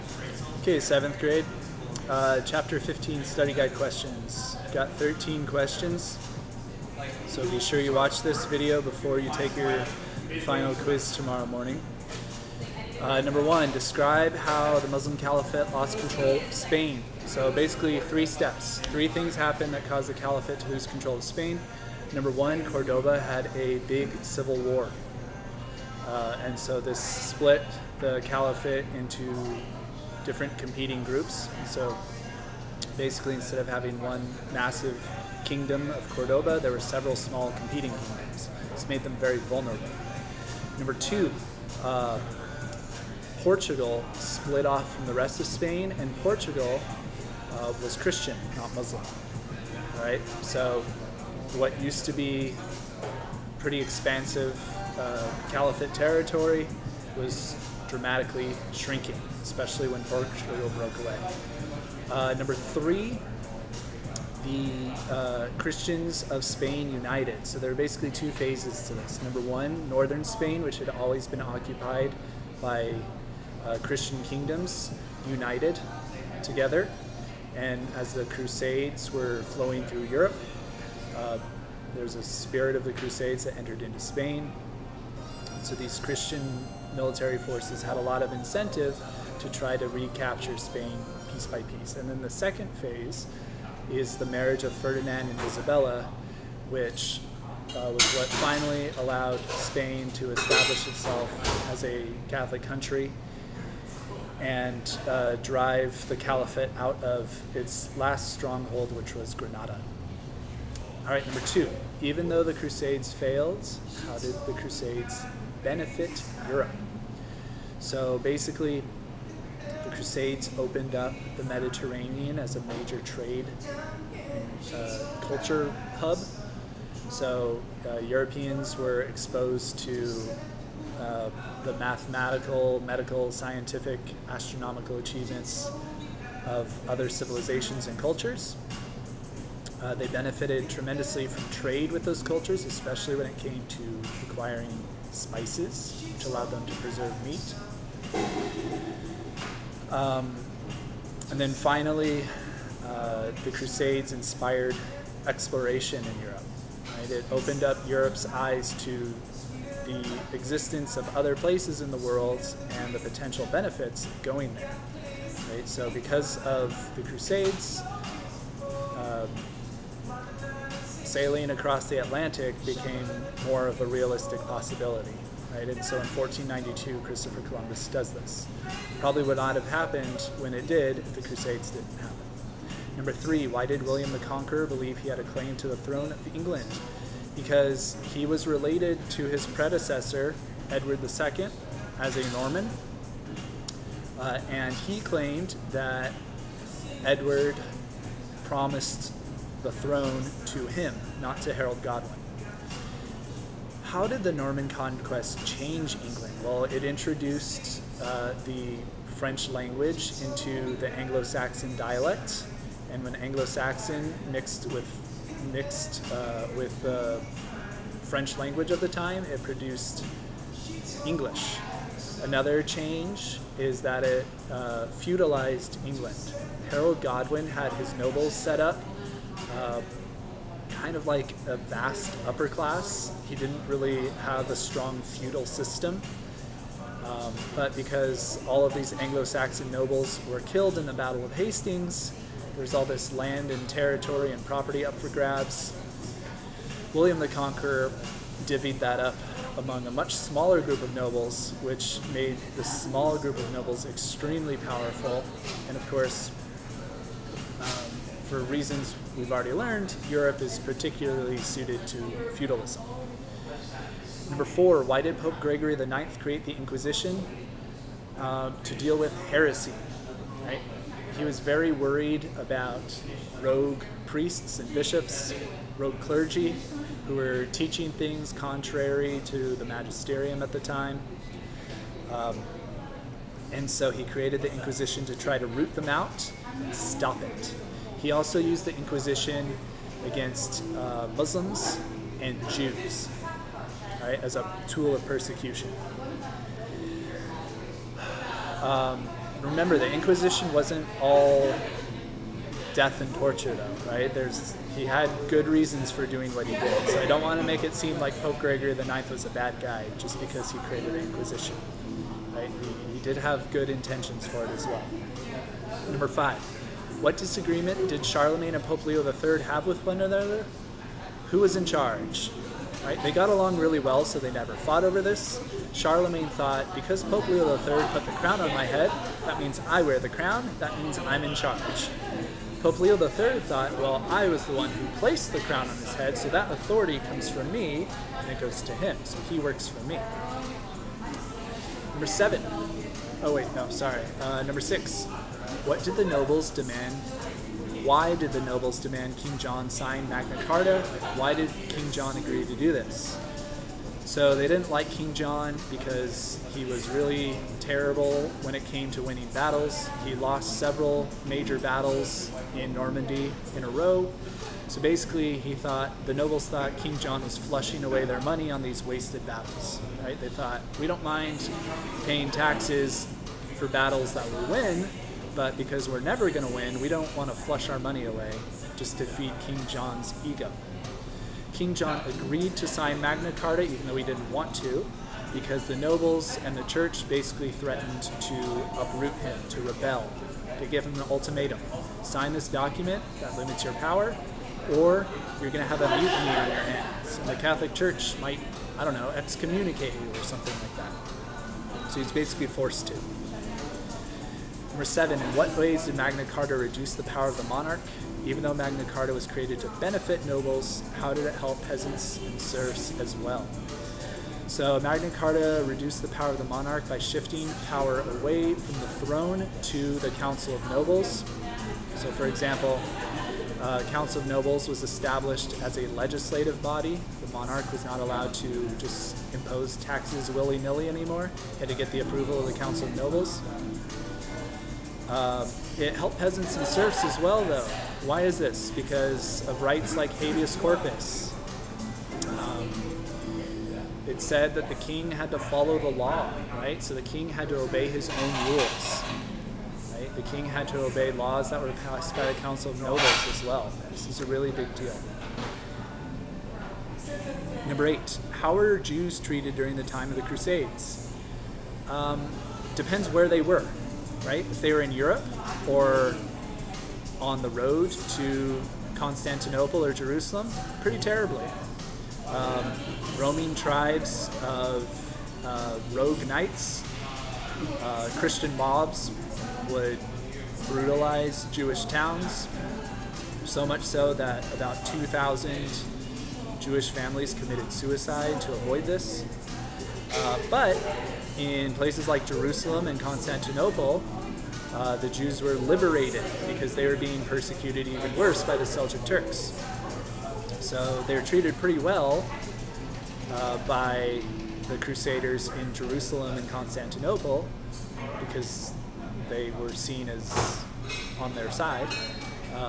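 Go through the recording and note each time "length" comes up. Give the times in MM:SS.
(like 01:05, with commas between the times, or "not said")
not said.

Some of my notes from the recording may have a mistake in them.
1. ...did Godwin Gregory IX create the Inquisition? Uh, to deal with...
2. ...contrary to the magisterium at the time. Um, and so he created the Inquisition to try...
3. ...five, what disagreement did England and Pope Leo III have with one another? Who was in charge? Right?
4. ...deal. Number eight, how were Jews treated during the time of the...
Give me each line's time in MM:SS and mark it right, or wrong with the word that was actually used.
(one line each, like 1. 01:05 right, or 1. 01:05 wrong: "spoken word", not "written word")
1. 04:24 wrong: "Pope", not "Godwin"
2. 04:38 right
3. 05:16 wrong: "Charlemagne", not "England"
4. 07:34 right.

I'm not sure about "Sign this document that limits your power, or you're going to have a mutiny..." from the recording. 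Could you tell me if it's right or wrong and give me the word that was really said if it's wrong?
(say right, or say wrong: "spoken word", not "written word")
right.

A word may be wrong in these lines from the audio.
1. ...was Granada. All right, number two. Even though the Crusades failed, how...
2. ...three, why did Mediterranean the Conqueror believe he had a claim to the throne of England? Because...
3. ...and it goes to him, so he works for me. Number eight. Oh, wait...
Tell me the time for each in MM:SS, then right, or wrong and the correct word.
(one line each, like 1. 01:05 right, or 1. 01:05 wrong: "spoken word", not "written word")
1. 01:49 right
2. 03:03 wrong: "William", not "Mediterranean"
3. 05:38 wrong: "seven", not "eight".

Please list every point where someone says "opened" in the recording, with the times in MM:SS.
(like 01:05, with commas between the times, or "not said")
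02:00, 02:37.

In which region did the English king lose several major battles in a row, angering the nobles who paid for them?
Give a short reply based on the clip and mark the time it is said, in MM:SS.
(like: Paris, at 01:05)
Normandy, at 06:02.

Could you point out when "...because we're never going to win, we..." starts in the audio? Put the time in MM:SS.
06:15.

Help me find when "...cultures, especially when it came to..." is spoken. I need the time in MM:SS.
02:22.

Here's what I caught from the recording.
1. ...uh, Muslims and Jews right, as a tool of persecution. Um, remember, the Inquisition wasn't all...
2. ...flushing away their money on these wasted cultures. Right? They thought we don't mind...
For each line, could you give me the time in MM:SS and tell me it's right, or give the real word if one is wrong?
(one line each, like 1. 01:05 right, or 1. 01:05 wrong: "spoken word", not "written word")
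1. 04:50 right
2. 06:07 wrong: "battles", not "cultures".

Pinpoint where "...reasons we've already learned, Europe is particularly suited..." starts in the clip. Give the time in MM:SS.
04:18.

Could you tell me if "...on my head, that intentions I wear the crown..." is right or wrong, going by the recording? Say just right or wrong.
wrong.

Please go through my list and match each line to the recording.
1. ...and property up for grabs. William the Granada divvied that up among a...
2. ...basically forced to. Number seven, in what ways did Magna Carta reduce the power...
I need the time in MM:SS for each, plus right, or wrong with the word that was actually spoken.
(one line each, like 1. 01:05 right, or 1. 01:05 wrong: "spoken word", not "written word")
1. 04:04 wrong: "Conqueror", not "Granada"
2. 06:42 right.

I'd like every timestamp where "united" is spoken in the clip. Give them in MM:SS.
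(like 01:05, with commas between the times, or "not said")
01:06, 01:15.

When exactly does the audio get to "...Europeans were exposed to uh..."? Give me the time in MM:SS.
02:07.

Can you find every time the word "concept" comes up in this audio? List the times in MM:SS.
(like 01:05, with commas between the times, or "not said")
not said.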